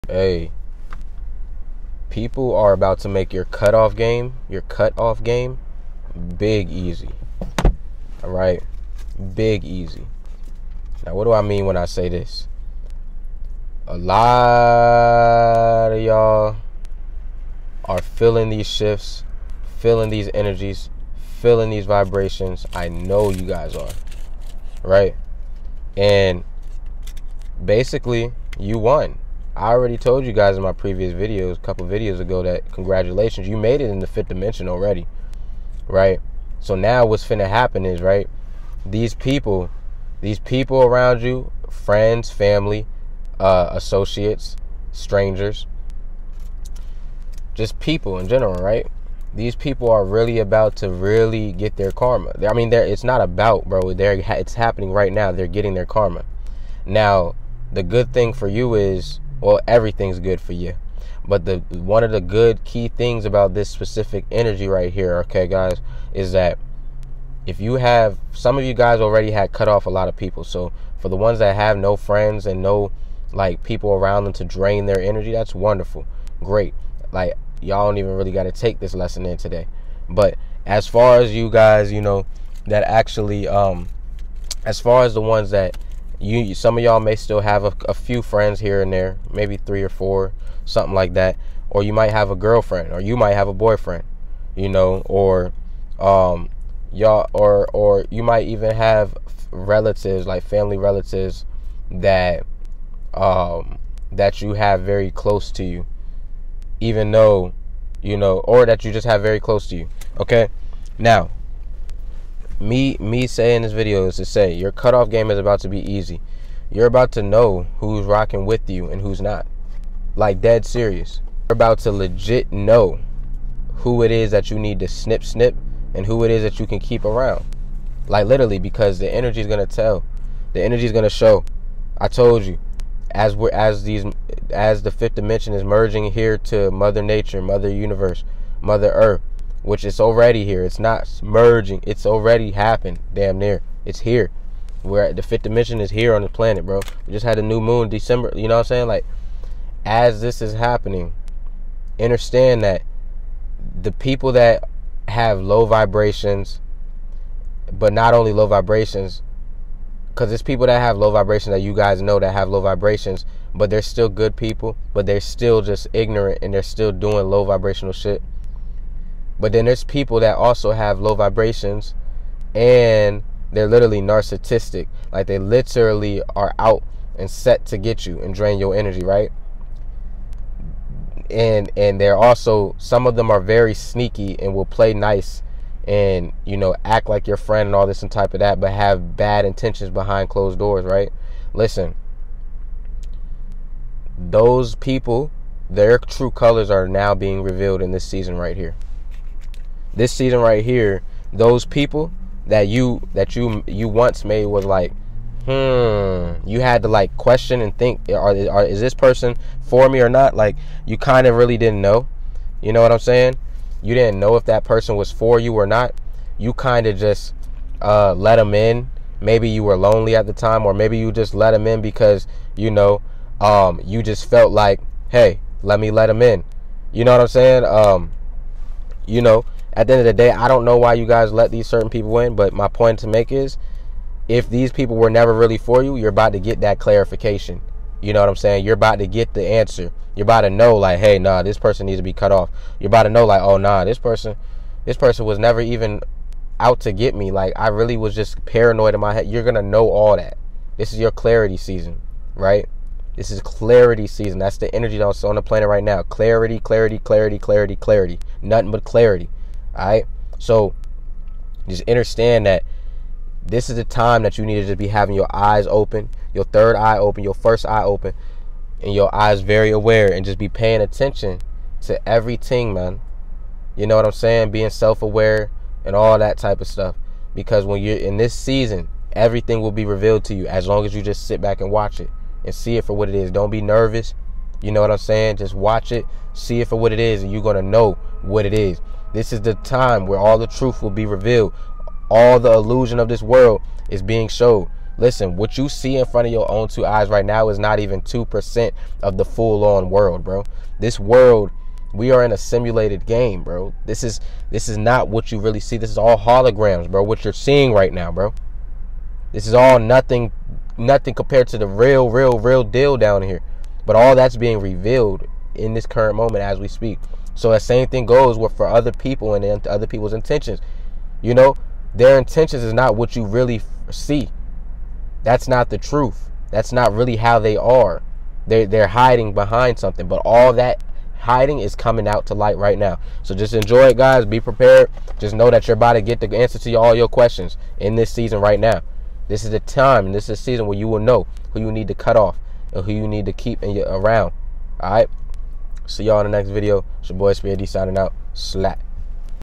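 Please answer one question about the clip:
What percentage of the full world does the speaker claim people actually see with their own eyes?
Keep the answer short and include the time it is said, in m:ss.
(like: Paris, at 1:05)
2%, at 4:58.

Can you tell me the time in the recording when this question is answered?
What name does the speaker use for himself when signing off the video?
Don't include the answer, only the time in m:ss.
5:47.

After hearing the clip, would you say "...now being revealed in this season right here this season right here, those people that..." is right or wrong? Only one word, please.
right.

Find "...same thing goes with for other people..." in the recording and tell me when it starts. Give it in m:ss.
5:17.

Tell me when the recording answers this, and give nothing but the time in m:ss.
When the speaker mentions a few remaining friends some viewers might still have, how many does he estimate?
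1:29.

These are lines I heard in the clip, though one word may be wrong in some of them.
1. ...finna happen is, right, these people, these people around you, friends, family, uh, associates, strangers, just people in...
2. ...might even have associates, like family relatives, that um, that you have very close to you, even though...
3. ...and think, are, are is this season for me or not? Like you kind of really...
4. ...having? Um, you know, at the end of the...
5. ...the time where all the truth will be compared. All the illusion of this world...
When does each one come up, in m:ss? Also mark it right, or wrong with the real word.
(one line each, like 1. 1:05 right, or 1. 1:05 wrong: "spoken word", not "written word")
1. 0:37 right
2. 1:38 wrong: "relatives", not "associates"
3. 3:27 wrong: "person", not "season"
4. 3:47 wrong: "saying", not "having"
5. 4:49 wrong: "revealed", not "compared".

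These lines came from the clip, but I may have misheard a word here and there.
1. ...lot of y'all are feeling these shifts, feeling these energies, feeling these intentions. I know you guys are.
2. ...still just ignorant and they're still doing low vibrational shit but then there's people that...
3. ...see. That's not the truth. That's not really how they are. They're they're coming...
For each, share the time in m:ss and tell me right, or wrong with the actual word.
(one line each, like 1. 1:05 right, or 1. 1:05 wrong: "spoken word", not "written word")
1. 0:13 wrong: "vibrations", not "intentions"
2. 2:45 right
3. 5:23 wrong: "hiding", not "coming".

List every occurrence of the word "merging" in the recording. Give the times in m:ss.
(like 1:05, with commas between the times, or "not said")
2:15, 2:21.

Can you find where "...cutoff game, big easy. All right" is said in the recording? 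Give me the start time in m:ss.
0:04.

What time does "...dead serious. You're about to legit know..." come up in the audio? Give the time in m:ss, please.
2:00.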